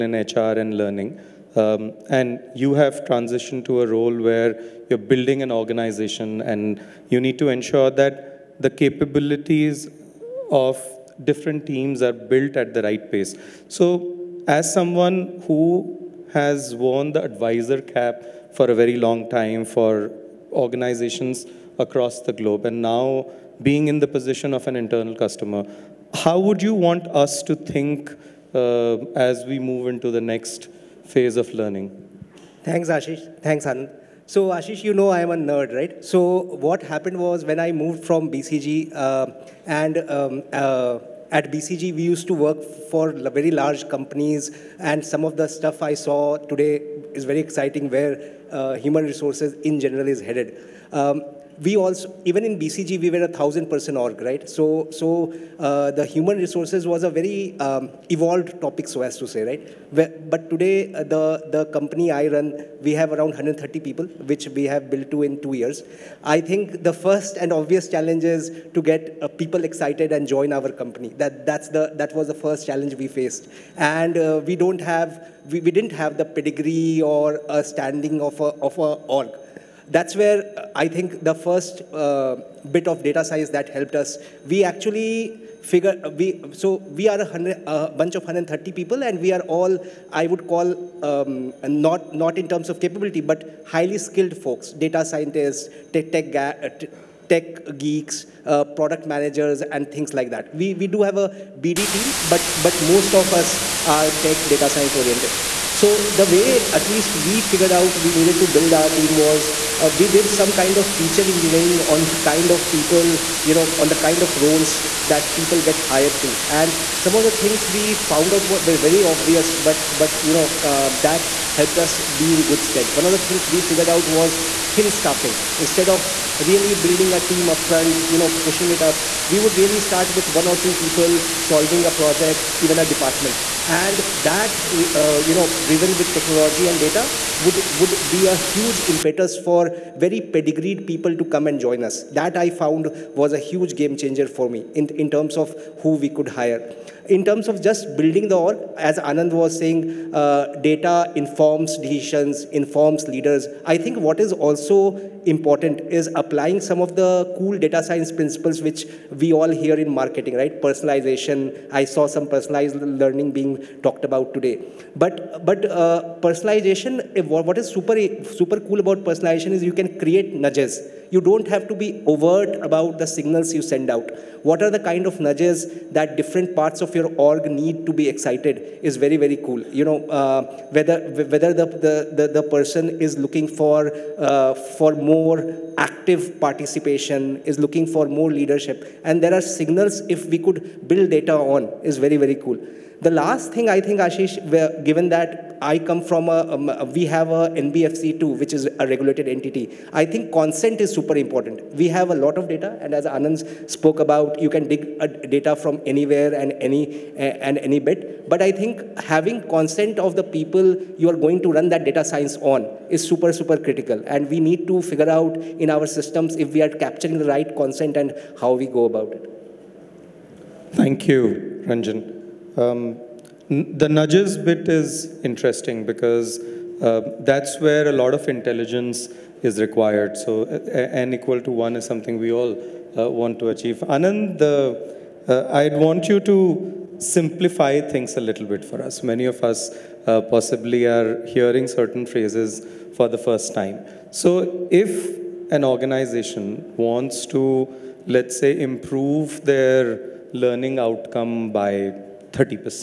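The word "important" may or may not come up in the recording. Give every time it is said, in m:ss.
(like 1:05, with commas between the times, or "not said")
2:35, 3:21.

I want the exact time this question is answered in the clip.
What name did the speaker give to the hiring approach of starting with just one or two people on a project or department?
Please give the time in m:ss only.
2:04.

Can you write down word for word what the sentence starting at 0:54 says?
So so uh, the human resources was a very um, evolved topic, so as to say, right?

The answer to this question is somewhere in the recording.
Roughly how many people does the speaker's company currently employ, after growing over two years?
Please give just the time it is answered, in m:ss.
1:02.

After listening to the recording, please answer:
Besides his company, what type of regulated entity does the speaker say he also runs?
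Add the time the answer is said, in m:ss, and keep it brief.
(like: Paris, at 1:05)
NBFC, at 3:16.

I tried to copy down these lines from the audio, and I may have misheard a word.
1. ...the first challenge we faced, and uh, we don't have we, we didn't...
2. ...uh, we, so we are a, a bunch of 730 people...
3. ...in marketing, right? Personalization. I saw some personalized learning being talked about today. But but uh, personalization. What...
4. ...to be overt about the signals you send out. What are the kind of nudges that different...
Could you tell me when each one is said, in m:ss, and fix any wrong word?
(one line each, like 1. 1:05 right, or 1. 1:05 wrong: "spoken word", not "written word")
1. 1:12 right
2. 1:26 wrong: "130", not "730"
3. 2:39 right
4. 2:51 right.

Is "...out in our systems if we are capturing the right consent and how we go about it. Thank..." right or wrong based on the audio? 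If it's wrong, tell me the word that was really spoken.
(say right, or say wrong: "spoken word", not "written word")
right.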